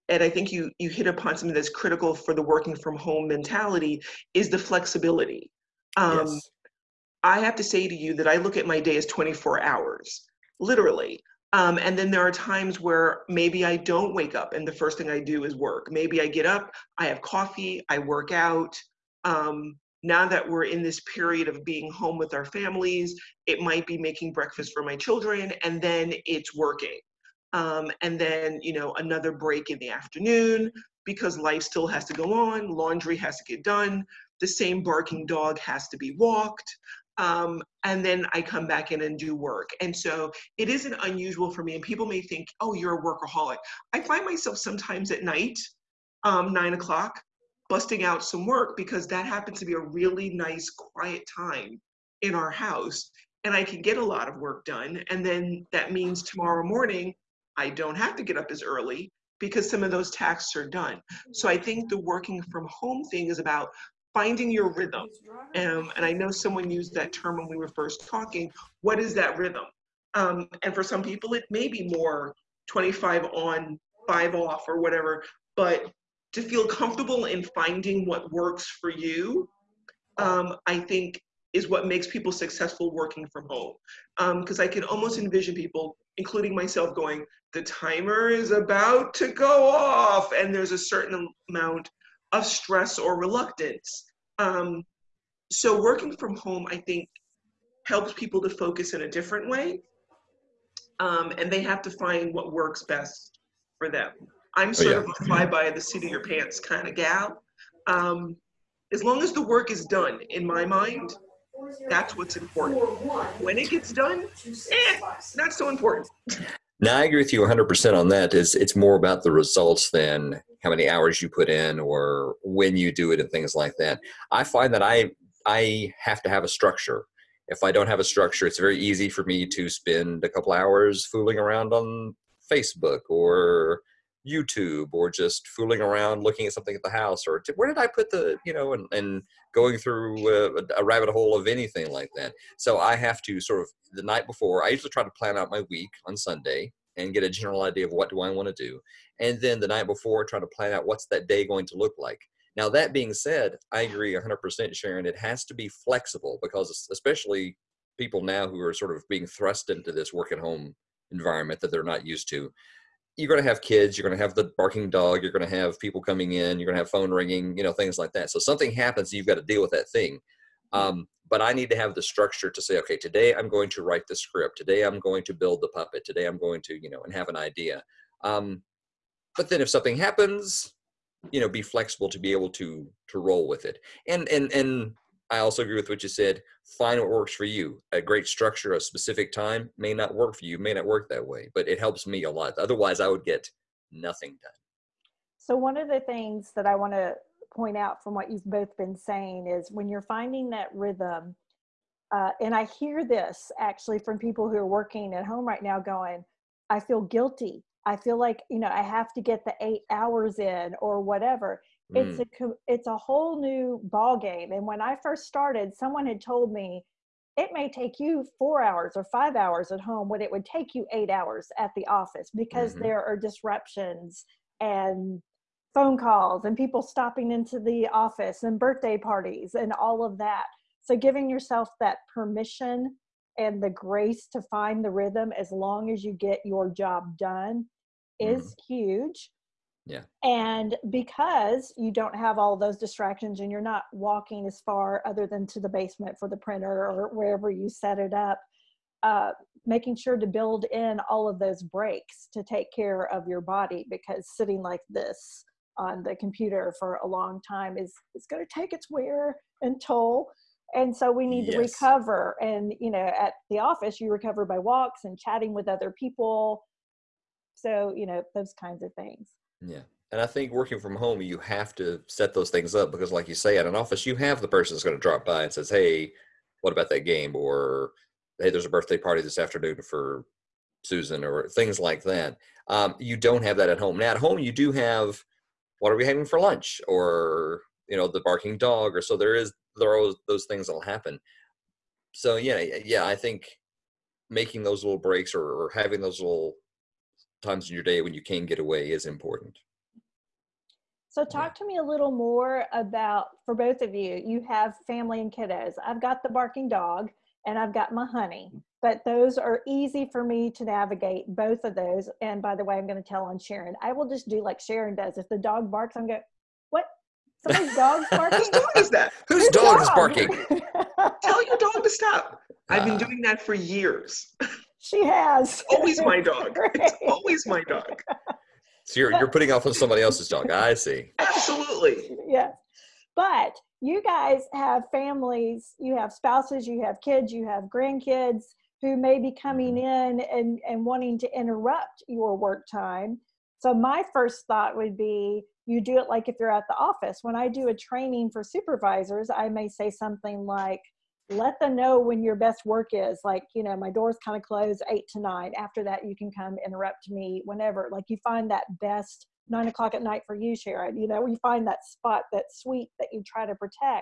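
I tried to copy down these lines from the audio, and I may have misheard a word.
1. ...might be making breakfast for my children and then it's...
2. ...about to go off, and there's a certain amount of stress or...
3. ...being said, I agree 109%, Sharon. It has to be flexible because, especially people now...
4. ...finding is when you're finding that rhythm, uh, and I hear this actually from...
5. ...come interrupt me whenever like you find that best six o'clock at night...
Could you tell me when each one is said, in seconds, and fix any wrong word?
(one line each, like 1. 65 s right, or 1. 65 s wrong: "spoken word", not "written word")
1. 23 s right
2. 88 s right
3. 152 s wrong: "100", not "109"
4. 198 s wrong: "saying", not "finding"
5. 356 s wrong: "nine", not "six".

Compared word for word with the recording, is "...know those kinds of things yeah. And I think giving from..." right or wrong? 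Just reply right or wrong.
wrong.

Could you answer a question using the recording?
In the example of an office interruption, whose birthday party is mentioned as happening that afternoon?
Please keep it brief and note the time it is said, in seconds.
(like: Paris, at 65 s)
Susan, at 280 s.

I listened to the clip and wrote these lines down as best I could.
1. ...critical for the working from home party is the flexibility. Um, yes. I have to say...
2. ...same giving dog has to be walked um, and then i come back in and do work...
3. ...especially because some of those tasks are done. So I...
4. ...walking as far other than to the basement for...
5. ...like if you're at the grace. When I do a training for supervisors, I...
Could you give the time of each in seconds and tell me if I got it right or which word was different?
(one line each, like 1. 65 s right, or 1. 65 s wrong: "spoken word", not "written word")
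1. 1 s wrong: "mentality", not "party"
2. 34 s wrong: "barking", not "giving"
3. 58 s wrong: "early", not "especially"
4. 243 s right
5. 346 s wrong: "office", not "grace".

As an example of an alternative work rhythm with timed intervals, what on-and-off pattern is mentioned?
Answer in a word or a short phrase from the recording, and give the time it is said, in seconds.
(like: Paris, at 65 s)
25 on, 5 off, at 72 s.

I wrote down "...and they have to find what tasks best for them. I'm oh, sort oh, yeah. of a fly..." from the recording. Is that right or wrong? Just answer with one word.
wrong.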